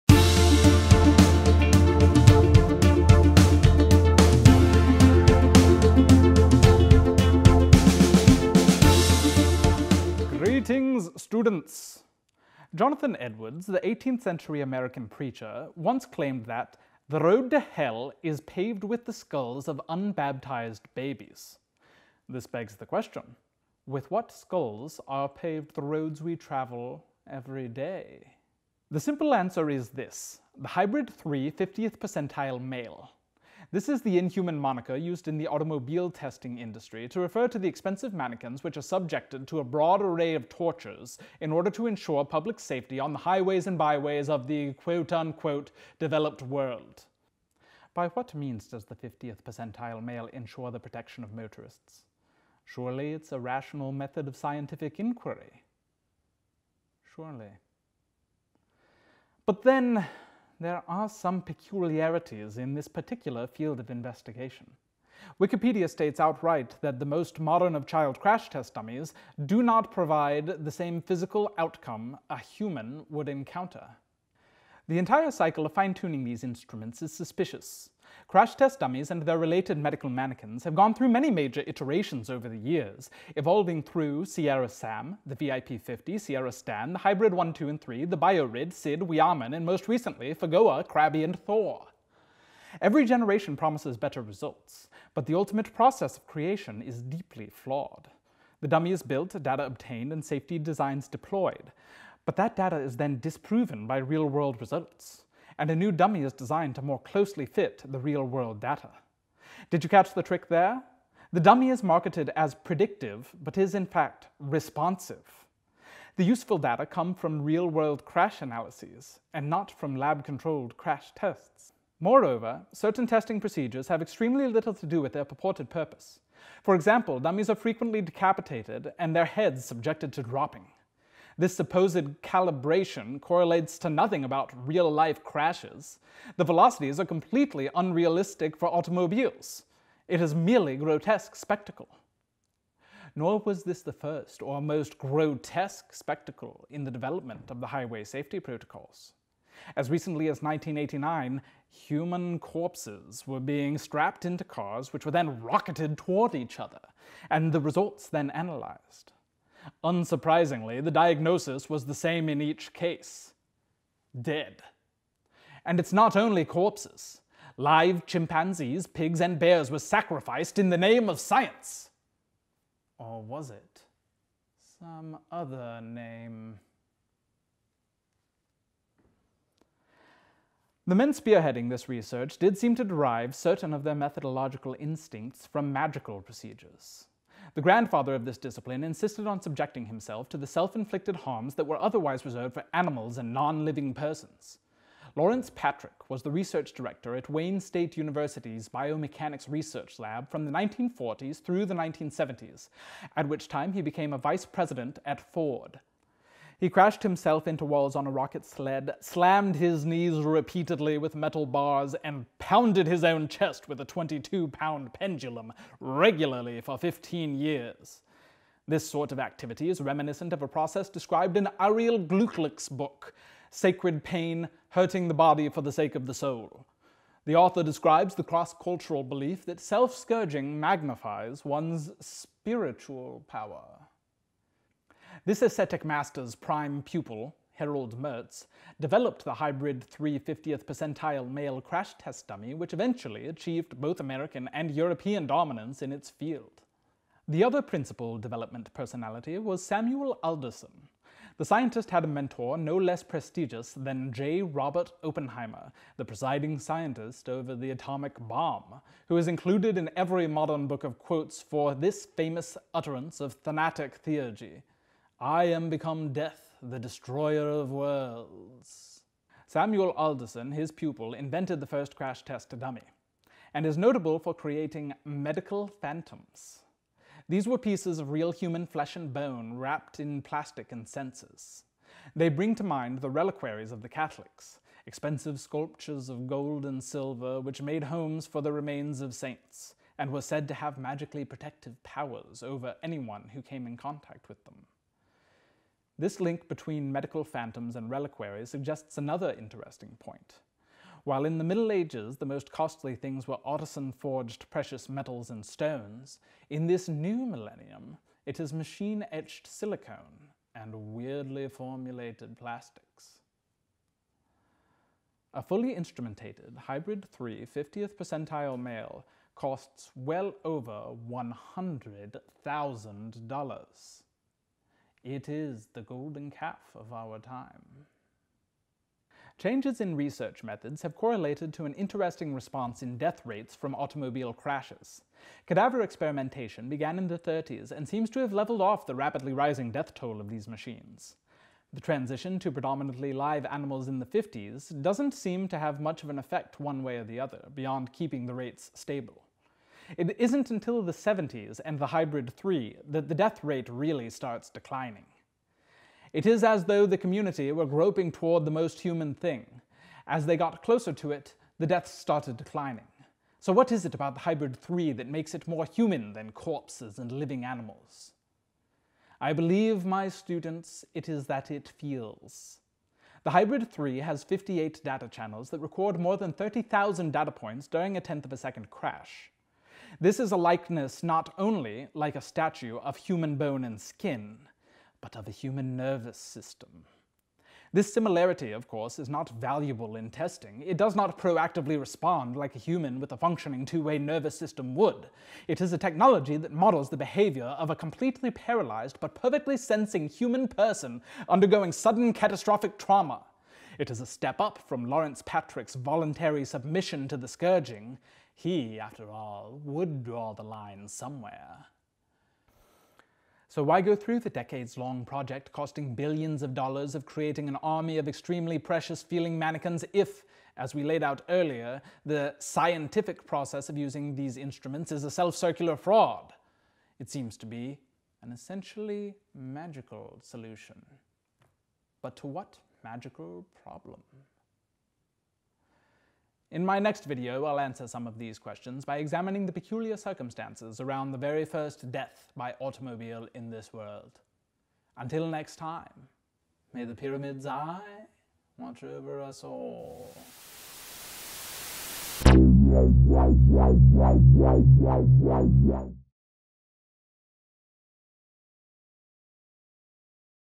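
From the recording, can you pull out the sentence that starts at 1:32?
Every generation promises better results, but the ultimate process of creation is deeply flawed.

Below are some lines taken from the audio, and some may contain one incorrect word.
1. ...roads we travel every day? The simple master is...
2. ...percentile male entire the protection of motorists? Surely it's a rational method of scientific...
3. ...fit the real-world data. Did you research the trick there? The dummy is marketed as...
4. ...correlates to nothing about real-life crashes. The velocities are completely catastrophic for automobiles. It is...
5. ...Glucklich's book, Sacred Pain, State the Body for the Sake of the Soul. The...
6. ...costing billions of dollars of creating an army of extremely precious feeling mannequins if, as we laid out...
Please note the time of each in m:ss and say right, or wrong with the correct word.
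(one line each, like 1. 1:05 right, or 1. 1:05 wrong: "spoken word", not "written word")
1. 0:25 wrong: "answer", not "master"
2. 0:49 wrong: "ensure", not "entire"
3. 1:47 wrong: "catch", not "research"
4. 2:13 wrong: "unrealistic", not "catastrophic"
5. 3:41 wrong: "Hurting", not "State"
6. 6:55 right.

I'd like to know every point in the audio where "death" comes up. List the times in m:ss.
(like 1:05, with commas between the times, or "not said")
4:26, 5:32, 5:39, 5:53, 6:01, 7:21.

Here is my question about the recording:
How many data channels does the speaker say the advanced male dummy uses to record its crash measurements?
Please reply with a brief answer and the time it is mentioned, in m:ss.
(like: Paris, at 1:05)
58, at 6:14.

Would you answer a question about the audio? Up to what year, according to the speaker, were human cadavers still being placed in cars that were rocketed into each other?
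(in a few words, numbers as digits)
1989.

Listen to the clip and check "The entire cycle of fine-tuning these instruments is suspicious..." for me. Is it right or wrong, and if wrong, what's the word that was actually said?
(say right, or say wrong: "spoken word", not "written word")
right.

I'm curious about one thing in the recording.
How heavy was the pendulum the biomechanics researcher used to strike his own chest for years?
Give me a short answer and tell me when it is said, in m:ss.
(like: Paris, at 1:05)
22 pounds, at 3:33.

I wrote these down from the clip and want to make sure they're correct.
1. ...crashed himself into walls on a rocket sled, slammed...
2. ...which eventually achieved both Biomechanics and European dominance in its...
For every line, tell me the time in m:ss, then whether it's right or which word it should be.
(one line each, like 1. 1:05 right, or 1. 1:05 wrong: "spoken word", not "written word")
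1. 3:26 right
2. 4:02 wrong: "American", not "Biomechanics".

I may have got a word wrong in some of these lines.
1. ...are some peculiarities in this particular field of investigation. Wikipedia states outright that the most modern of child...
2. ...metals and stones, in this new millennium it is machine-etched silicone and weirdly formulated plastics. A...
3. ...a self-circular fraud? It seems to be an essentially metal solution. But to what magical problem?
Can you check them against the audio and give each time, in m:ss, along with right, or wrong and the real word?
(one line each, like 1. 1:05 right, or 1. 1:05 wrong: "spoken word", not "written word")
1. 1:00 right
2. 5:04 right
3. 7:05 wrong: "magical", not "metal".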